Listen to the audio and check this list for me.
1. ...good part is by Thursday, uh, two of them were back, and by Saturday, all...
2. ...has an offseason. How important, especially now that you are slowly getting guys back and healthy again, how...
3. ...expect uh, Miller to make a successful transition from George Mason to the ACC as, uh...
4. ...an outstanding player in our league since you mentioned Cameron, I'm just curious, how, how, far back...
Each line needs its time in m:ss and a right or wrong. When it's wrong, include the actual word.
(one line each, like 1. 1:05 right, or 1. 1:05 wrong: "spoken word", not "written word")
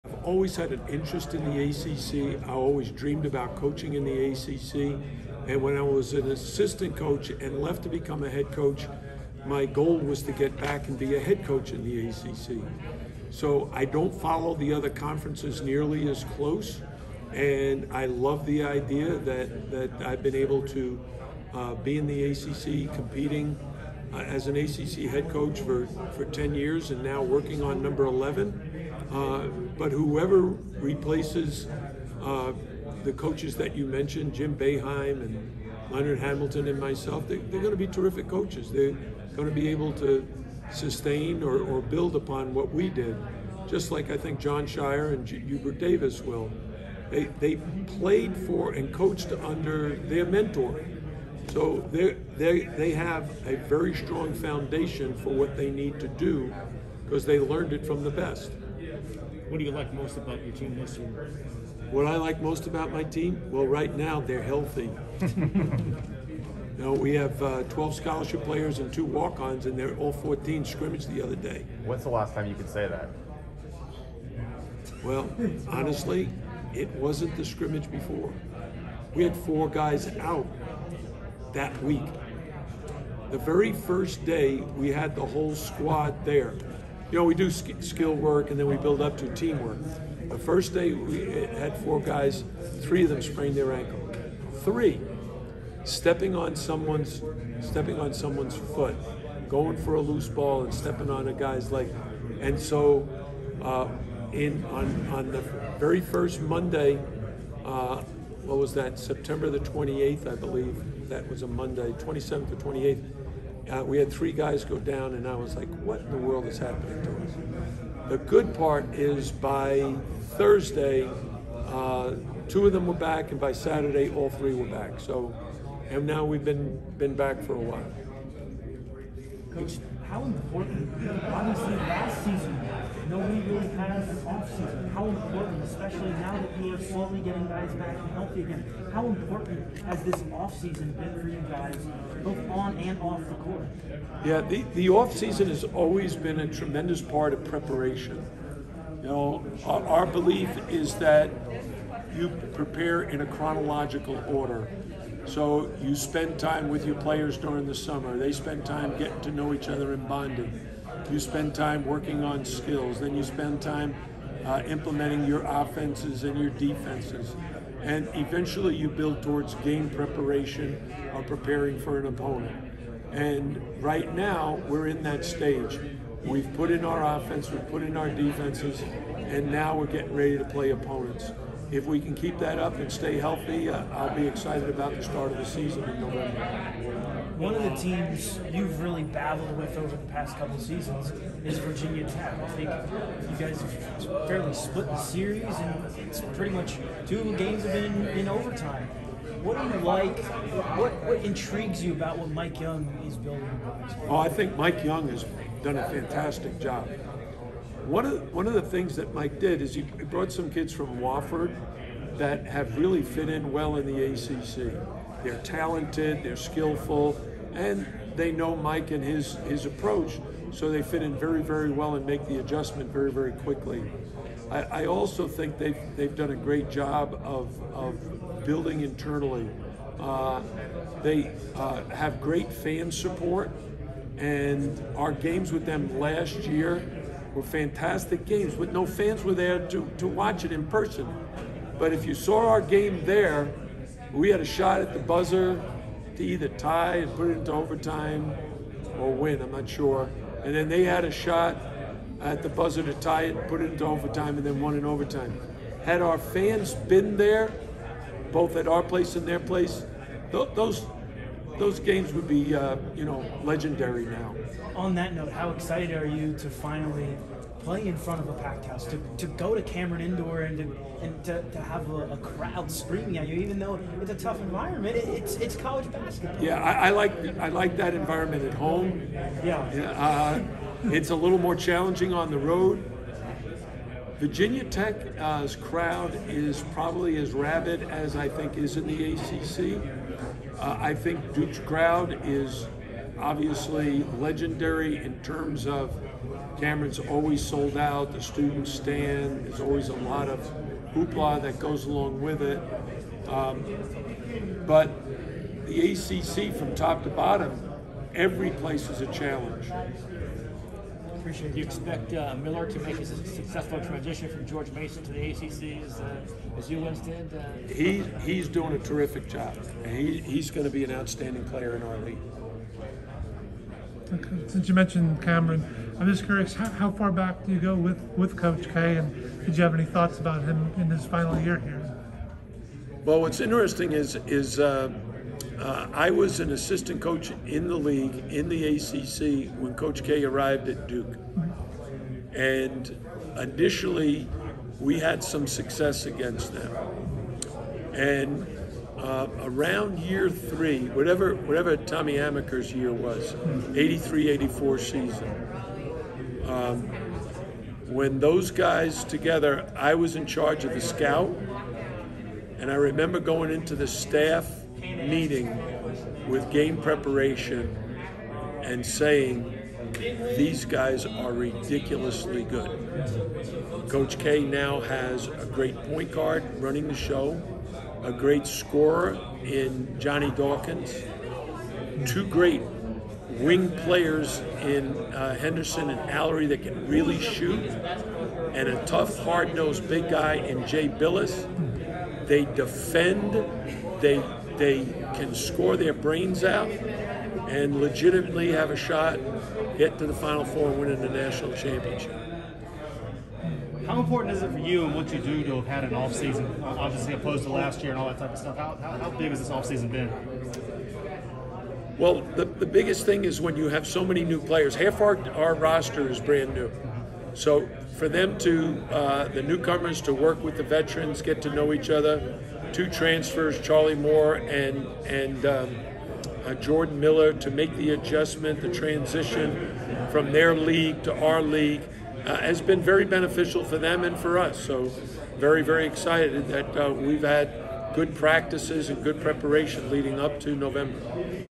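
1. 1:58 right
2. 2:13 right
3. 5:11 right
4. 5:20 right.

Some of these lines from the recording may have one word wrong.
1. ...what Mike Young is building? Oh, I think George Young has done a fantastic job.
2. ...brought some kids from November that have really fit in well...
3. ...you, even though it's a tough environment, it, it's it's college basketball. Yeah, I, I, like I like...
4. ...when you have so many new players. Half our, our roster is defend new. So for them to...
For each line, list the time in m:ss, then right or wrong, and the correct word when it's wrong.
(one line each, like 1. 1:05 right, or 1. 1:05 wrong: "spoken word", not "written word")
1. 3:22 wrong: "Mike", not "George"
2. 3:29 wrong: "Wofford", not "November"
3. 4:33 right
4. 6:53 wrong: "brand", not "defend".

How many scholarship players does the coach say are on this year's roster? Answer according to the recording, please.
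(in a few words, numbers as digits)
12.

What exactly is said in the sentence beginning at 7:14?
So, very, very excited that uh, we've had good practices and good preparation leading up to November.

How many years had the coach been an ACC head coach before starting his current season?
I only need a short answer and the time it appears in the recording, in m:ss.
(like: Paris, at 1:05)
10, at 0:26.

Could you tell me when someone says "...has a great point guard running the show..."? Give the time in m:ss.
6:14.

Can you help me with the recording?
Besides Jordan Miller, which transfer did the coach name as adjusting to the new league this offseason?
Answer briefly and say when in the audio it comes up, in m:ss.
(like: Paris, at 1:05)
Charlie Moore, at 7:03.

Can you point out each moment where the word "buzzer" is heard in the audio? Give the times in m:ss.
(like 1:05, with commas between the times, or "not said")
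4:04, 4:12.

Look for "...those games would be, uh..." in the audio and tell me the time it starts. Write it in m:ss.
4:21.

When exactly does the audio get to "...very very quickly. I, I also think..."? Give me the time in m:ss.
3:42.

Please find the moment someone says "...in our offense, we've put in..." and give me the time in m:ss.
2:56.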